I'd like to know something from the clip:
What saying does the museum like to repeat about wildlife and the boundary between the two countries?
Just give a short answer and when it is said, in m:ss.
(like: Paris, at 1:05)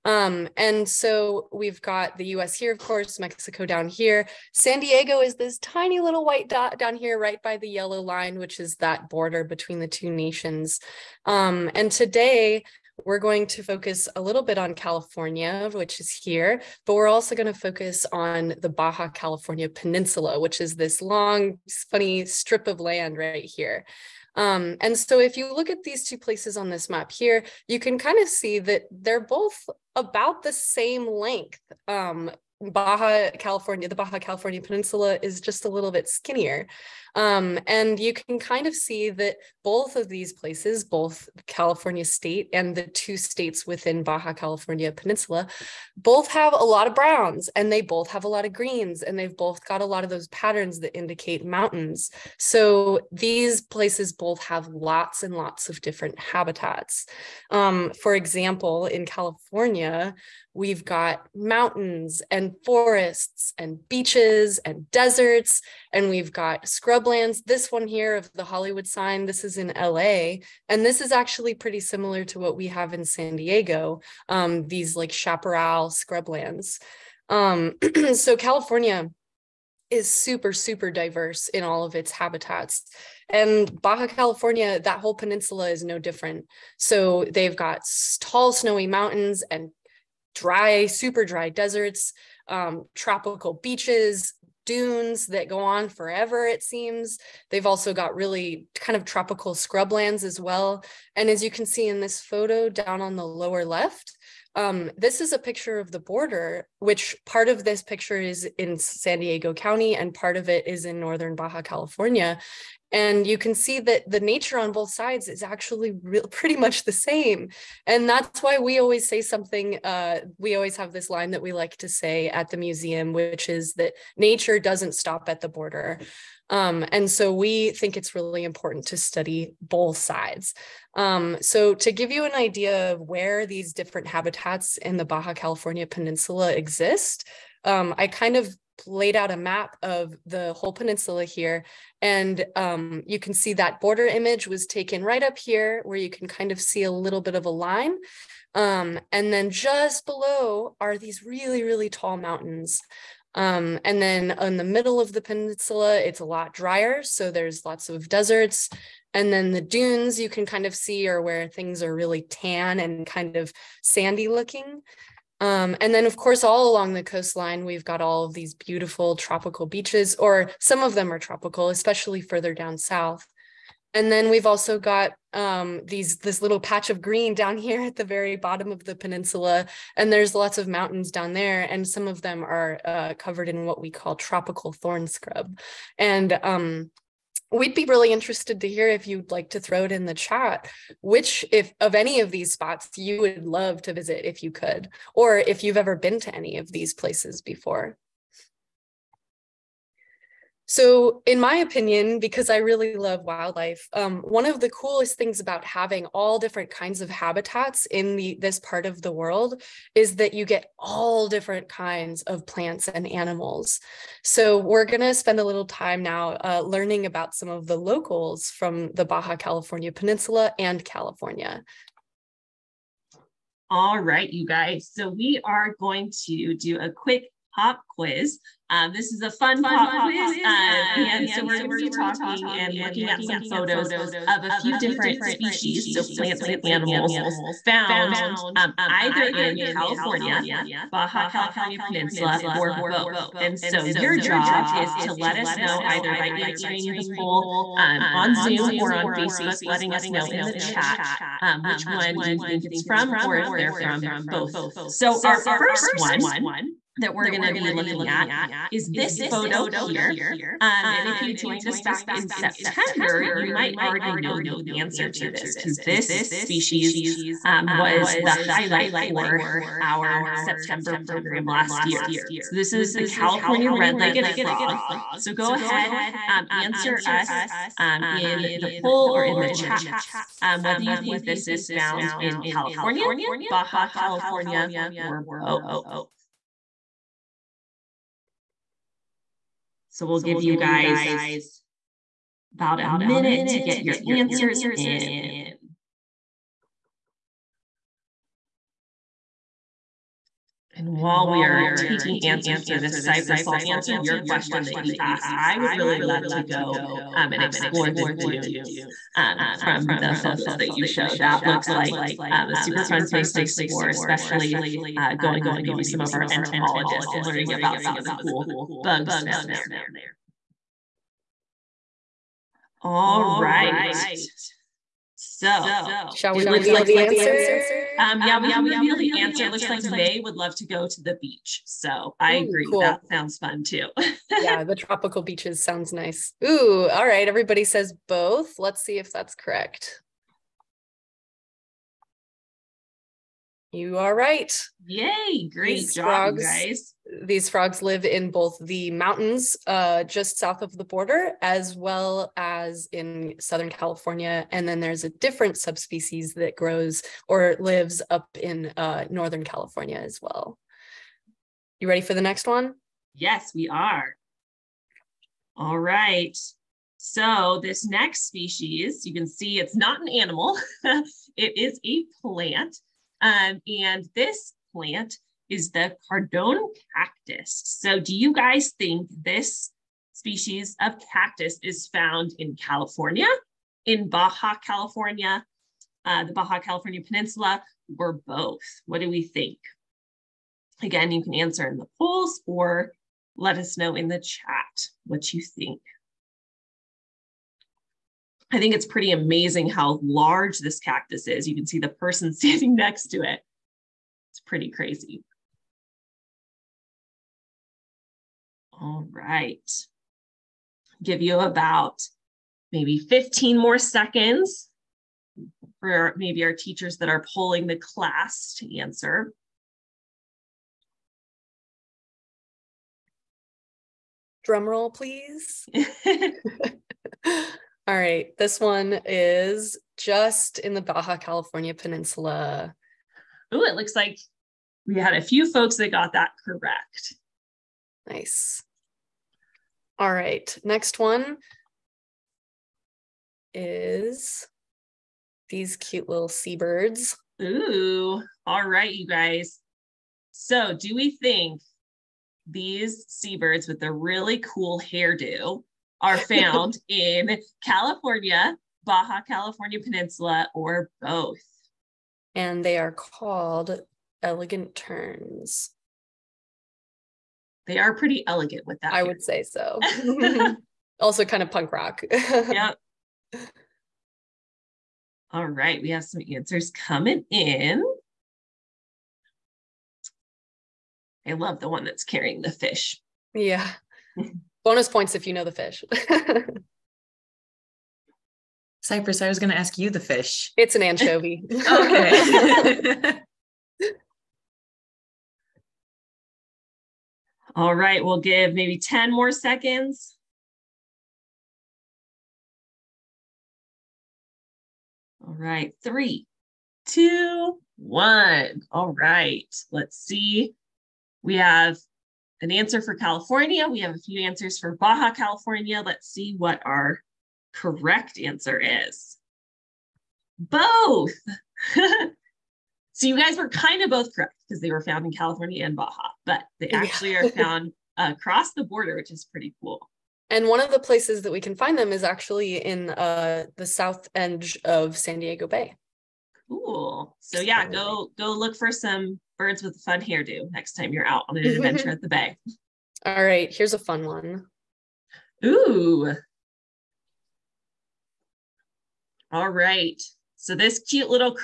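Nature doesn't stop at the border, at 2:04.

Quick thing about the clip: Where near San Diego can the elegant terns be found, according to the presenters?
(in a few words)
South edge of San Diego Bay.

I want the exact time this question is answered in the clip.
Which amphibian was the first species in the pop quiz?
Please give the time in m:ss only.
4:33.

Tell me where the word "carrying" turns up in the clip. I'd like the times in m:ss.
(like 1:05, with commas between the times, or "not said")
8:02.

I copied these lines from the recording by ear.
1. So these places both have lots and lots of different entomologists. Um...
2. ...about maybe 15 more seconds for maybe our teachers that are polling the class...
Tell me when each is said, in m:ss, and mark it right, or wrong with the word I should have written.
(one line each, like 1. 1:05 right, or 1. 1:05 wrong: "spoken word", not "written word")
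1. 0:52 wrong: "habitats", not "entomologists"
2. 6:51 right.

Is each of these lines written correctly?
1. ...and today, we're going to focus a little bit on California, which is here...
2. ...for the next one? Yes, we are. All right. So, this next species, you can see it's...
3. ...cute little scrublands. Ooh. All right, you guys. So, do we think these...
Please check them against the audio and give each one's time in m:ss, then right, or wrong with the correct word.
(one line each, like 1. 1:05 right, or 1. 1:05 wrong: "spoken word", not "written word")
1. 0:11 right
2. 6:02 right
3. 7:25 wrong: "seabirds", not "scrublands".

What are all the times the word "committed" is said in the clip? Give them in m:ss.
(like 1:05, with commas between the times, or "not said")
not said.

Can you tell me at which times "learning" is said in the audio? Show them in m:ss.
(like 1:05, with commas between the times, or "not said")
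3:36, 5:17.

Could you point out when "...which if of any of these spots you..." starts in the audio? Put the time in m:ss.
3:11.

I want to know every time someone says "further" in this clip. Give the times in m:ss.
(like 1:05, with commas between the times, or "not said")
2:52.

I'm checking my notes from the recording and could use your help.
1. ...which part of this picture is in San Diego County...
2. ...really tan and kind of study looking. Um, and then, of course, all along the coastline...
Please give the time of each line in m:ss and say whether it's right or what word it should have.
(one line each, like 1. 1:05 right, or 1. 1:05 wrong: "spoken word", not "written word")
1. 1:46 right
2. 2:41 wrong: "sandy", not "study".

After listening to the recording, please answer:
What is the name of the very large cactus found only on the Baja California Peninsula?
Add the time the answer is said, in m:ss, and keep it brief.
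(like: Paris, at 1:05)
Cardon cactus, at 6:16.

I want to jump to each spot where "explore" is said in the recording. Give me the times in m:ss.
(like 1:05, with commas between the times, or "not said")
5:07, 5:13.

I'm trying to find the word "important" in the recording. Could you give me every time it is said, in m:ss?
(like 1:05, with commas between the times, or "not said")
2:08.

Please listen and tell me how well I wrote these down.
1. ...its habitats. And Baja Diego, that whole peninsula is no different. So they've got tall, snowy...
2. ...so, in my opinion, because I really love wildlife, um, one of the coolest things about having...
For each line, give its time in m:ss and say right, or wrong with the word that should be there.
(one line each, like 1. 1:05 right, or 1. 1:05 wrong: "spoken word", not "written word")
1. 1:21 wrong: "California", not "Diego"
2. 3:20 right.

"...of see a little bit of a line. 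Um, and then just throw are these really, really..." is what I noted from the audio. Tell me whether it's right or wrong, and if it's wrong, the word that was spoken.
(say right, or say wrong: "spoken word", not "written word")
wrong: "below", not "throw".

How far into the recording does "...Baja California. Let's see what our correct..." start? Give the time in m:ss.
8:34.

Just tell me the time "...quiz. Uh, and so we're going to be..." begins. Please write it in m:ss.
3:50.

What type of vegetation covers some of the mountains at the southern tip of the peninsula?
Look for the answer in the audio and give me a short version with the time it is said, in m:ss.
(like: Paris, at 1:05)
Tropical thorn scrub, at 3:04.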